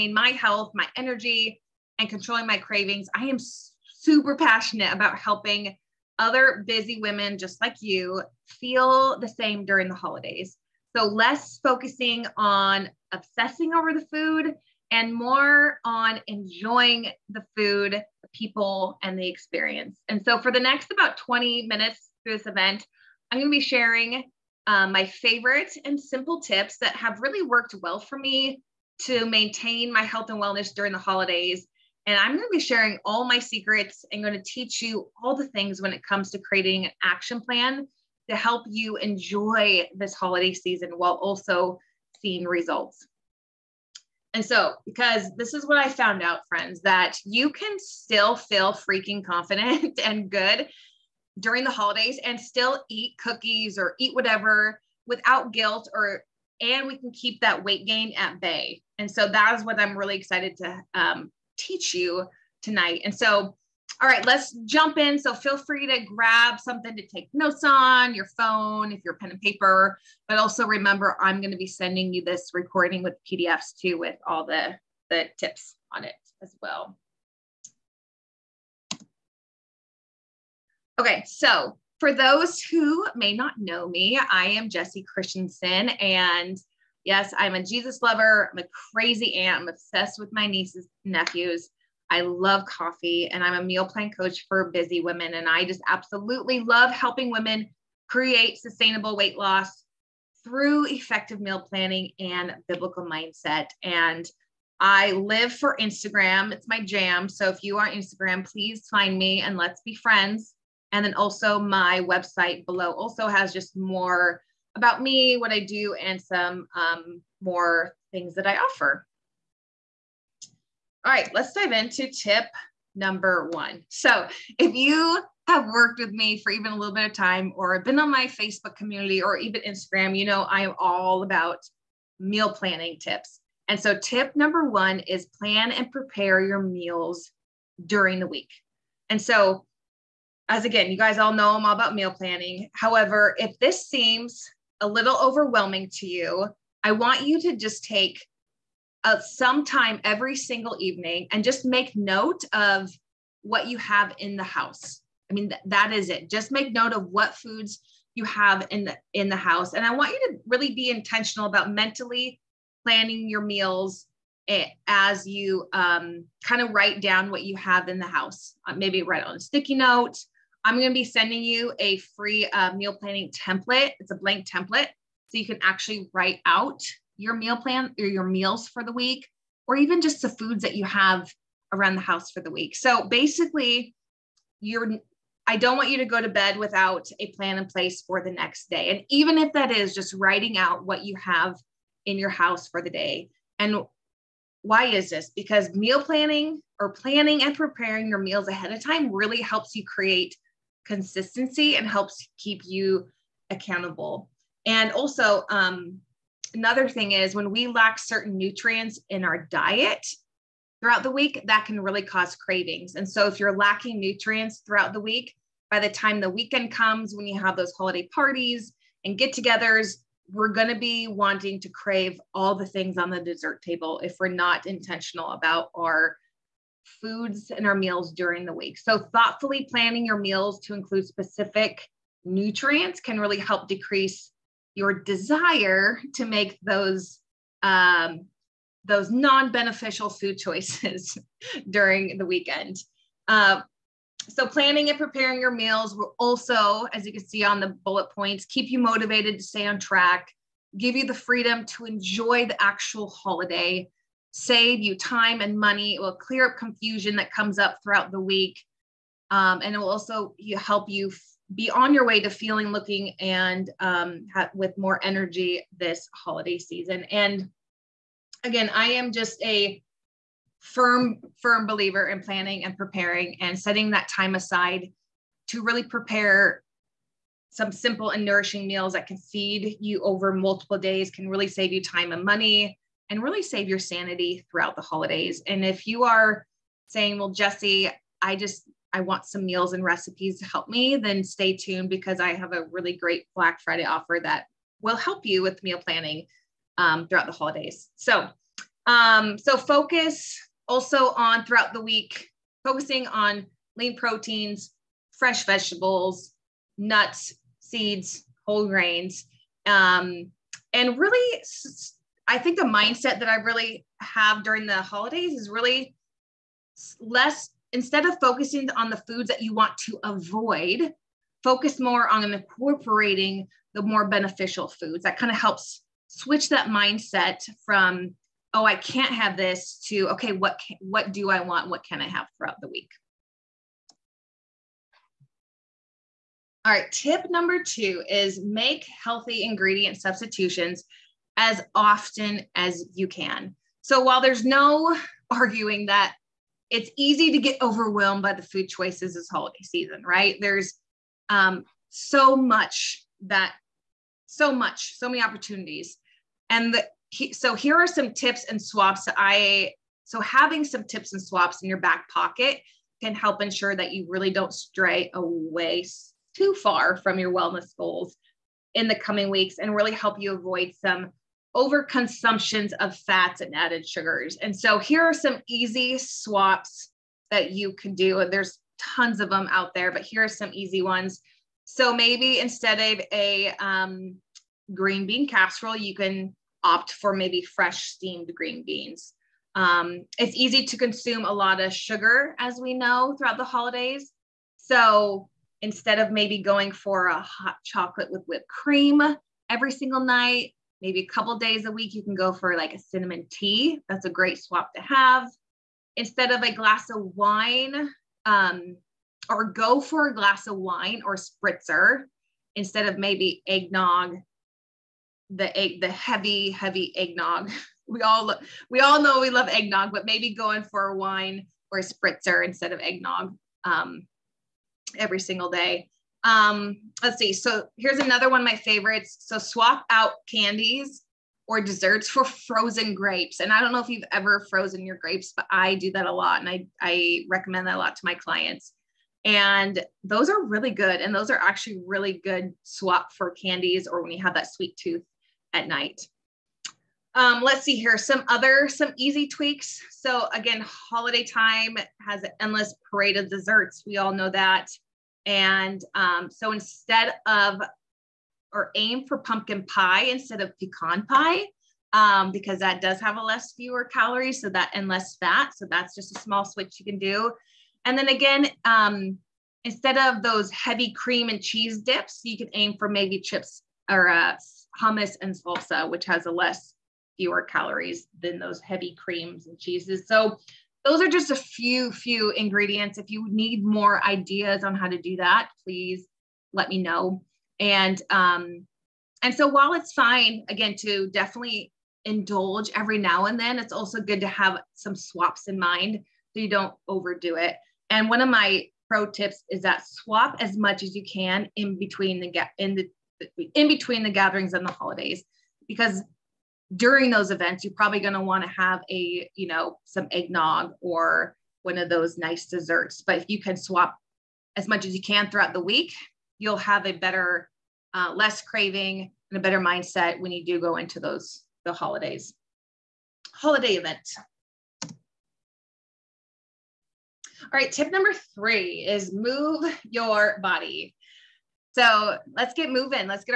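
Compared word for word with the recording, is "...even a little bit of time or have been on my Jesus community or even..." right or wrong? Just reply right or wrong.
wrong.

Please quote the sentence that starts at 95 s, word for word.
And I just absolutely love helping women create sustainable weight loss through effective meal planning and biblical mindset.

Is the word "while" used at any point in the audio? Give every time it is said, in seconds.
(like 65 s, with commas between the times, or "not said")
40 s, 344 s, 489 s.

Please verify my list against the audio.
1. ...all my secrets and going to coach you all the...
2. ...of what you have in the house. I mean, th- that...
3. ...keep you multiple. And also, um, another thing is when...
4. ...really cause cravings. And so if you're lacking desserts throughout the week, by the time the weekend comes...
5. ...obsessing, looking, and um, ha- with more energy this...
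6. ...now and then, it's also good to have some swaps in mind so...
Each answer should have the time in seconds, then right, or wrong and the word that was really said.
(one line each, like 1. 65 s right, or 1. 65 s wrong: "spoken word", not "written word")
1. 33 s wrong: "teach", not "coach"
2. 152 s right
3. 202 s wrong: "accountable", not "multiple"
4. 211 s wrong: "nutrients", not "desserts"
5. 262 s wrong: "feeling", not "obsessing"
6. 492 s right.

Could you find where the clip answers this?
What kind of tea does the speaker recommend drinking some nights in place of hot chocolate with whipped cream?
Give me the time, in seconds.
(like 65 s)
402 s.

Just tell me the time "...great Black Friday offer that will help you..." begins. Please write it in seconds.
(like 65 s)
292 s.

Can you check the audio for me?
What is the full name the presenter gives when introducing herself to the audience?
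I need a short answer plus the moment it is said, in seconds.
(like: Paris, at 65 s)
Jessie Christensen, at 84 s.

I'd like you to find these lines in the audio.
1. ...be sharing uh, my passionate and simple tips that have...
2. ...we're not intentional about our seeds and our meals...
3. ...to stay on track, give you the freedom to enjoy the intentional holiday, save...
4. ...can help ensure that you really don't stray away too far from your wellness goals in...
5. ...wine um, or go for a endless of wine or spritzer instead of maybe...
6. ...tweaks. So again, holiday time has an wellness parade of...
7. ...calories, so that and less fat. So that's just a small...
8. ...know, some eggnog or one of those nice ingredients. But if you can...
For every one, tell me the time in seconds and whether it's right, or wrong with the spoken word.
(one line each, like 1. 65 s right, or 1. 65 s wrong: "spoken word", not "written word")
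1. 23 s wrong: "favorite", not "passionate"
2. 224 s wrong: "foods", not "seeds"
3. 249 s wrong: "actual", not "intentional"
4. 363 s right
5. 407 s wrong: "glass", not "endless"
6. 449 s wrong: "endless", not "wellness"
7. 463 s right
8. 509 s wrong: "desserts", not "ingredients".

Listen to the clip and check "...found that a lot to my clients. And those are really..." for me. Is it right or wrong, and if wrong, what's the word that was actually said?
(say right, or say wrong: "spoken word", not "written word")
wrong: "recommend", not "found".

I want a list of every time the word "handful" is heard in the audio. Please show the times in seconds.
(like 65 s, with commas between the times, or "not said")
not said.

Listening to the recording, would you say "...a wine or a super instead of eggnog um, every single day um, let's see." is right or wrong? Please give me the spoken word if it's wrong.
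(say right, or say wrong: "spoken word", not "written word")
wrong: "spritzer", not "super".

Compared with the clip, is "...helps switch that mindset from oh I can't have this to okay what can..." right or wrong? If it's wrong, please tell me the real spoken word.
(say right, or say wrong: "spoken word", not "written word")
right.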